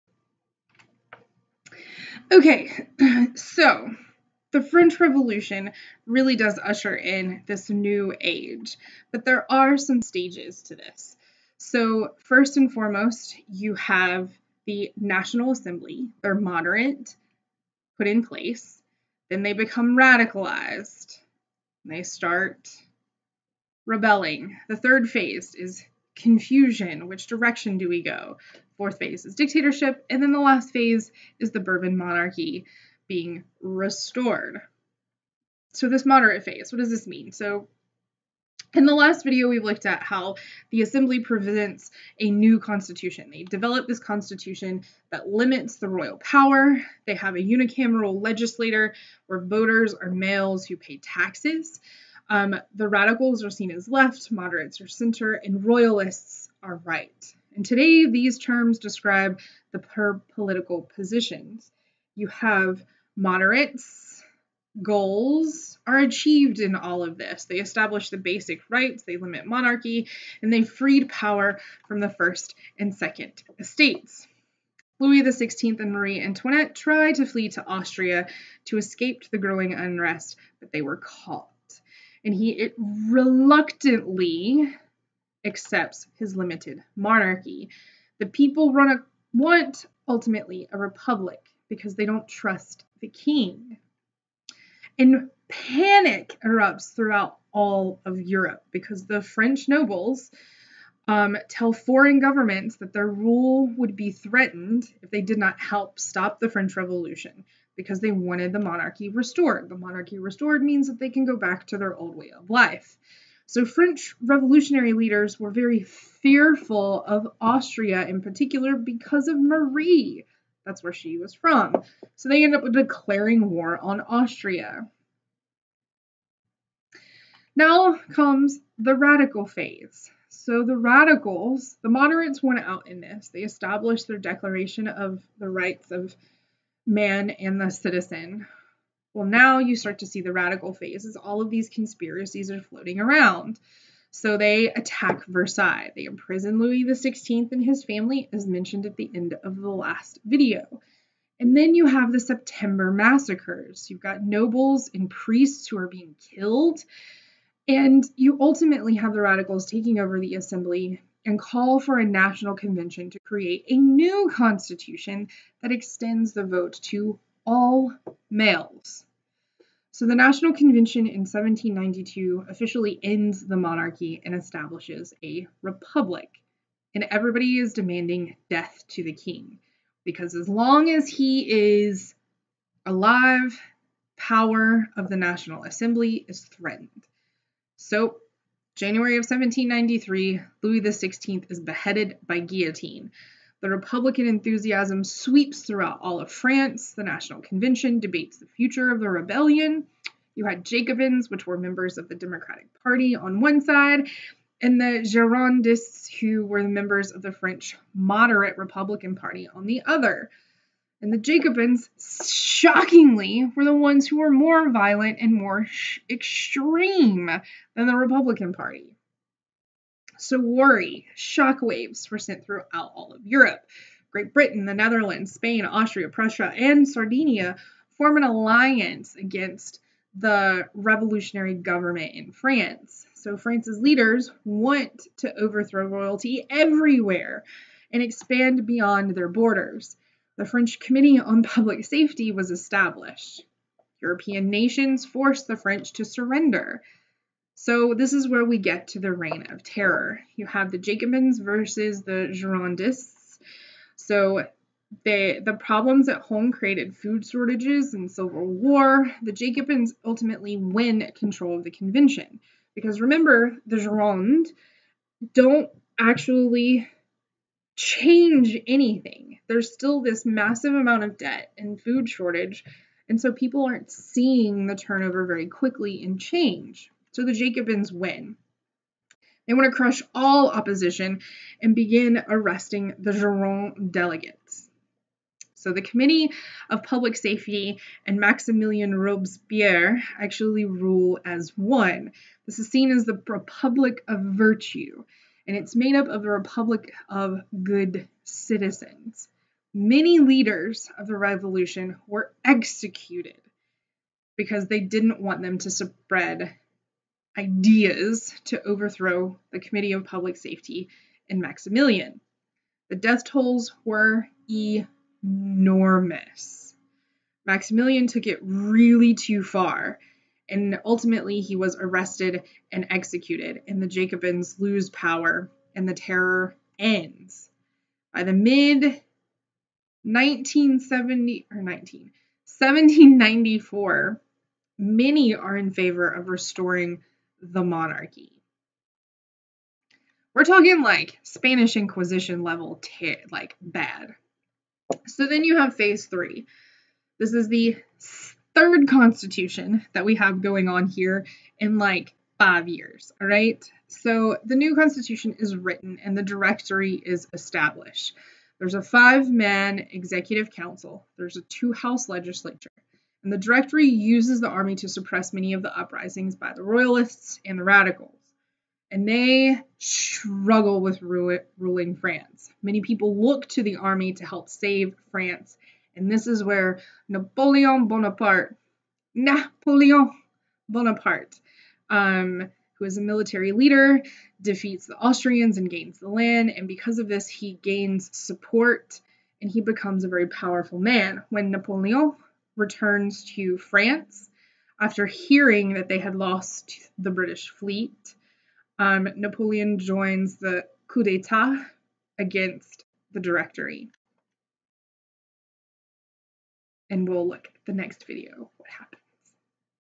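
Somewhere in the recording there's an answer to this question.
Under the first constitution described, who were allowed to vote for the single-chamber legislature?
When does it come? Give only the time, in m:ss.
0:50.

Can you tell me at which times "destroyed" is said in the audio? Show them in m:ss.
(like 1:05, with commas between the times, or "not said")
not said.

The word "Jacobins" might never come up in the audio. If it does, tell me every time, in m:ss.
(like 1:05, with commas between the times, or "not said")
3:20, 3:31, 4:10, 4:19, 4:37, 5:23.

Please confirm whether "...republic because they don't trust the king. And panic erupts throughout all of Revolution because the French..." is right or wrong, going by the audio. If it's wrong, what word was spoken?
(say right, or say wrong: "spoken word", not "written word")
wrong: "Europe", not "Revolution".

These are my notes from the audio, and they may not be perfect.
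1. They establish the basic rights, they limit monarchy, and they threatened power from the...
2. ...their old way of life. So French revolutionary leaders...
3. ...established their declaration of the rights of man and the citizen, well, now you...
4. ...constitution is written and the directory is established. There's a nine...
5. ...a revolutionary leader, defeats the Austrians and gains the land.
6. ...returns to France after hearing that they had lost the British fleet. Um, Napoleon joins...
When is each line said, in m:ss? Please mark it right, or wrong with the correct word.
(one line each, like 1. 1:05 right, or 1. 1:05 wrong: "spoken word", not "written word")
1. 1:07 wrong: "freed", not "threatened"
2. 1:51 right
3. 2:13 right
4. 5:54 wrong: "five", not "nine"
5. 6:22 wrong: "military", not "revolutionary"
6. 6:32 right.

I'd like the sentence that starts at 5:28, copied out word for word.
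By the mid 1970 or 19 1794, many are in favor of restoring the monarchy.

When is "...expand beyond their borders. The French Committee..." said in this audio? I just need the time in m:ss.
3:58.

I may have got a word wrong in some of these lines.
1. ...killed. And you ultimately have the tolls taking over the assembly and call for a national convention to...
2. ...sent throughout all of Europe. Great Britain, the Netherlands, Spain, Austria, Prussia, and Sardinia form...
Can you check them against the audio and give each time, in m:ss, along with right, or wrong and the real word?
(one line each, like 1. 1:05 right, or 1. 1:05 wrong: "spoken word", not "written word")
1. 2:36 wrong: "radicals", not "tolls"
2. 3:42 right.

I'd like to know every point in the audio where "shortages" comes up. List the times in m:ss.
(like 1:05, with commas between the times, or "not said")
4:17, 4:32.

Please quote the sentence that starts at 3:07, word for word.
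So, January of 1793, Louis XVI is beheaded by guillotine.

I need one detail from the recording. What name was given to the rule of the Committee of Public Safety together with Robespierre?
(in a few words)
Republic of Virtue.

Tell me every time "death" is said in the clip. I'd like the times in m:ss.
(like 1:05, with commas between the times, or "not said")
2:58, 5:12.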